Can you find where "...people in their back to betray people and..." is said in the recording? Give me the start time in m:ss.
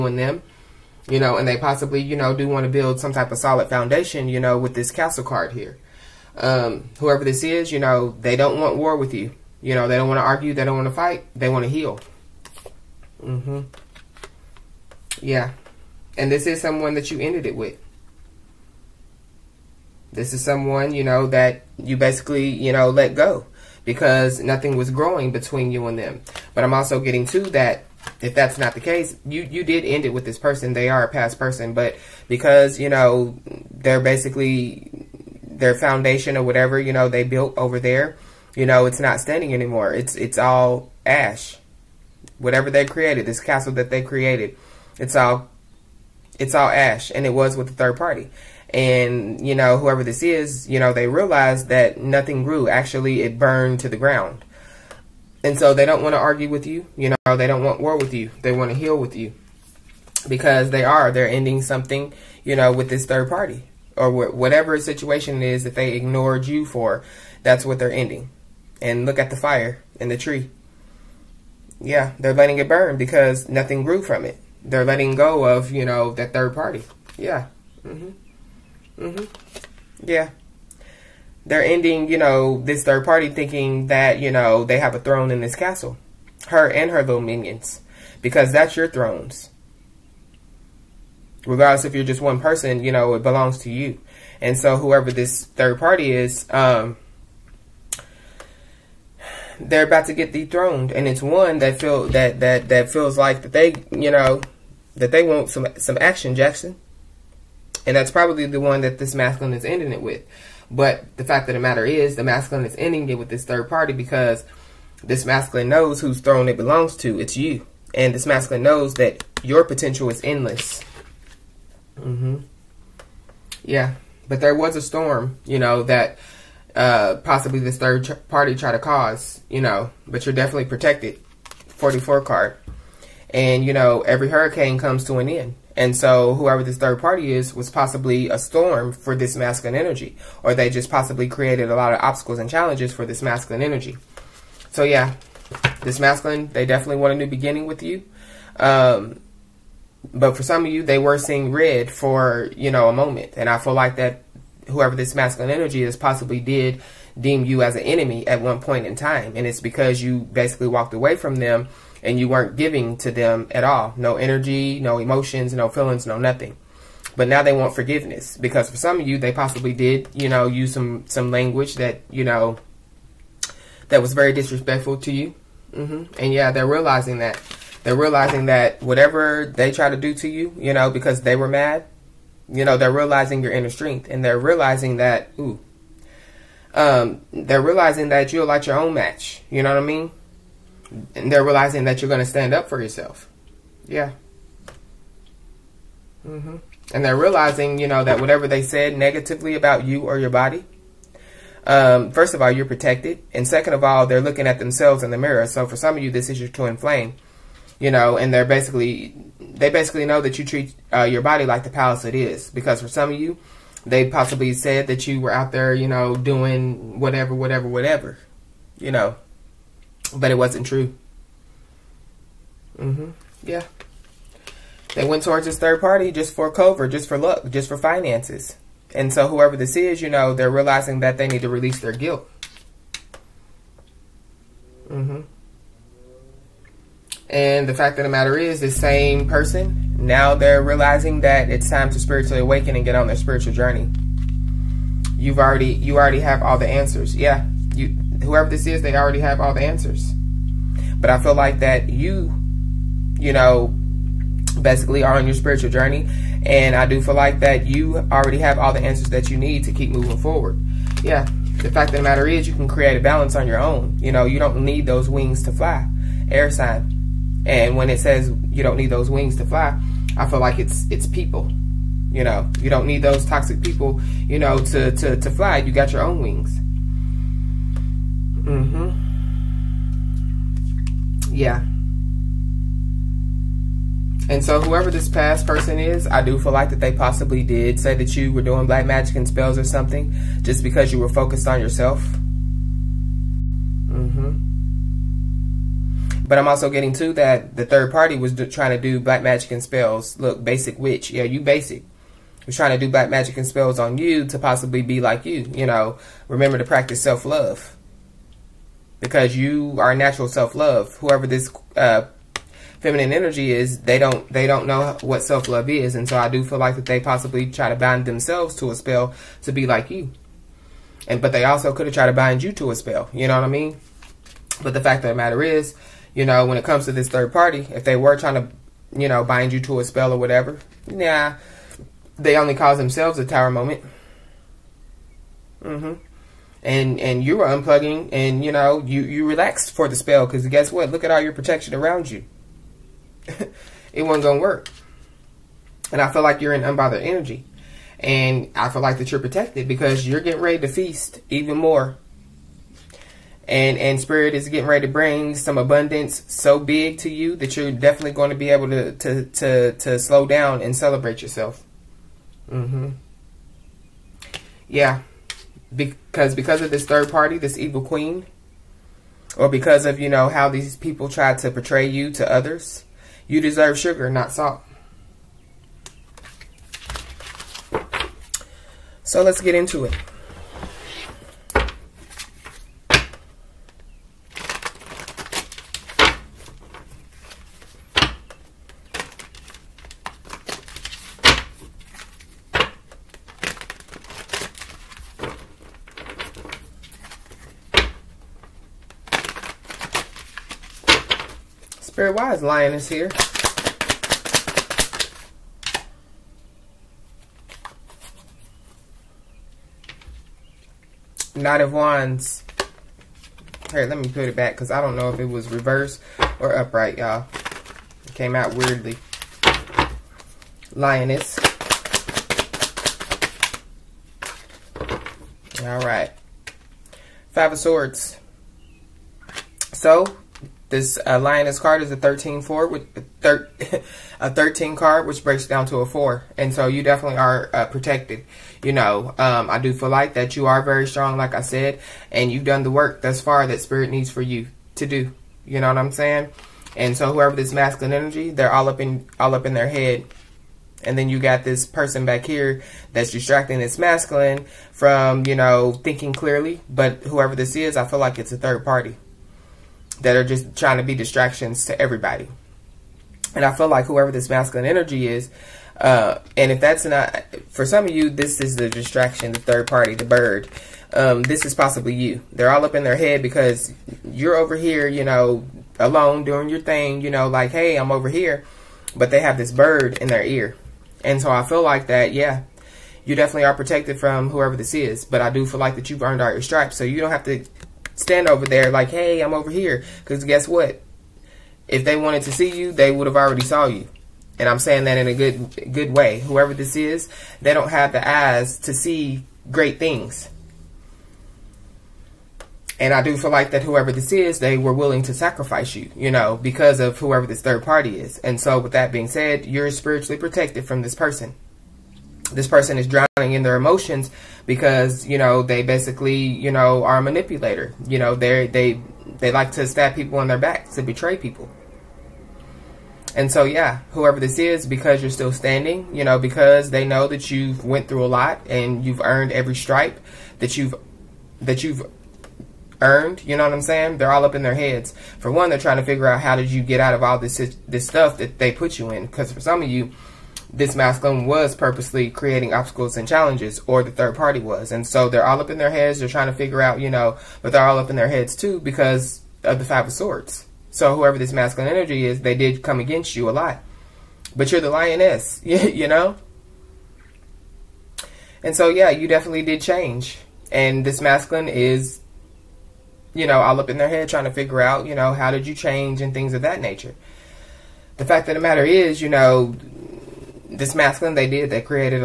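8:39.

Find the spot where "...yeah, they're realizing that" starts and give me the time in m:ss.
2:56.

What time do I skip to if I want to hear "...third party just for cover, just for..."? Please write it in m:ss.
3:45.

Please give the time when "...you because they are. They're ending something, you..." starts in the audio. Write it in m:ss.
0:59.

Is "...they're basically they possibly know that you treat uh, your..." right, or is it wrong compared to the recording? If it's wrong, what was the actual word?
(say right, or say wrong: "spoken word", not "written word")
wrong: "basically", not "possibly".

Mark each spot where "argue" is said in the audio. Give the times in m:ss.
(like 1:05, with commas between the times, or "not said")
0:10, 0:56.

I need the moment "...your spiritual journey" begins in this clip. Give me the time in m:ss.
4:15.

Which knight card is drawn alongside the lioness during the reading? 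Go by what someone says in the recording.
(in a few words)
Knight of Wands.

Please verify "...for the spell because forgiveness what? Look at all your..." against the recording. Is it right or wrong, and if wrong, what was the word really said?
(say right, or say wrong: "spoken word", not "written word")
wrong: "guess", not "forgiveness".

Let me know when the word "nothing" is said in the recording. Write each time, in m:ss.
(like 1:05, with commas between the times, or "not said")
0:24, 0:51, 1:13, 2:46.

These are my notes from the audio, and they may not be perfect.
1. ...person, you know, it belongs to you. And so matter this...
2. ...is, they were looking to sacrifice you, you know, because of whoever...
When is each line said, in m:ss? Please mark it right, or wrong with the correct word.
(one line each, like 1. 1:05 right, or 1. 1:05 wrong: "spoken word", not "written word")
1. 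1:32 wrong: "whoever", not "matter"
2. 8:24 wrong: "willing", not "looking".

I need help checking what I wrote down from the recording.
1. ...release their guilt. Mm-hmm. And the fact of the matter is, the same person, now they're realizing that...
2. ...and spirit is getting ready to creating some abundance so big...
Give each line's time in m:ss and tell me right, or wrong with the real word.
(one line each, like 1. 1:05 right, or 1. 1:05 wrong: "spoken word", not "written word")
1. 3:51 right
2. 5:53 wrong: "bring", not "creating".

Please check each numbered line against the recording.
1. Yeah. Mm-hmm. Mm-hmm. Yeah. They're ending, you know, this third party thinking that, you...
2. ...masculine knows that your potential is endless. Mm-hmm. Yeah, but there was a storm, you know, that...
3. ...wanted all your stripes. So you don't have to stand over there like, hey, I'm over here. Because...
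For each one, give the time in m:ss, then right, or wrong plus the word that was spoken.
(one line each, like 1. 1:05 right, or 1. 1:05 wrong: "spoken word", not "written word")
1. 1:17 right
2. 1:58 right
3. 8:06 wrong: "earned", not "wanted".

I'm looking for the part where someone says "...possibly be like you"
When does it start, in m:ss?
5:04.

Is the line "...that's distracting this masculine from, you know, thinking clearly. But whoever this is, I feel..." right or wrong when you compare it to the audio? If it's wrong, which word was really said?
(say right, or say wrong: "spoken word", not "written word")
right.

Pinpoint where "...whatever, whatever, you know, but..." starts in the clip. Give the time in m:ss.
3:37.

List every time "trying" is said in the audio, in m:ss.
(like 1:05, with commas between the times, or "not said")
4:58, 5:02, 5:28, 7:40, 8:55, 9:06, 9:24.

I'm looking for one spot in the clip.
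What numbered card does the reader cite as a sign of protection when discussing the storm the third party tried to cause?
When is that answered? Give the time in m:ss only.
2:11.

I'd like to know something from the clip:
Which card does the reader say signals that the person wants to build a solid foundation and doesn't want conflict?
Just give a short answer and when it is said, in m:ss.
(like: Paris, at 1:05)
castle card, at 0:04.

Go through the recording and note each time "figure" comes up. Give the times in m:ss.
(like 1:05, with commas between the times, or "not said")
8:55, 9:06, 9:24.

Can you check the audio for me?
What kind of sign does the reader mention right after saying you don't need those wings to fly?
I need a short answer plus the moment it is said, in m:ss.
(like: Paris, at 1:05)
Air sign, at 4:26.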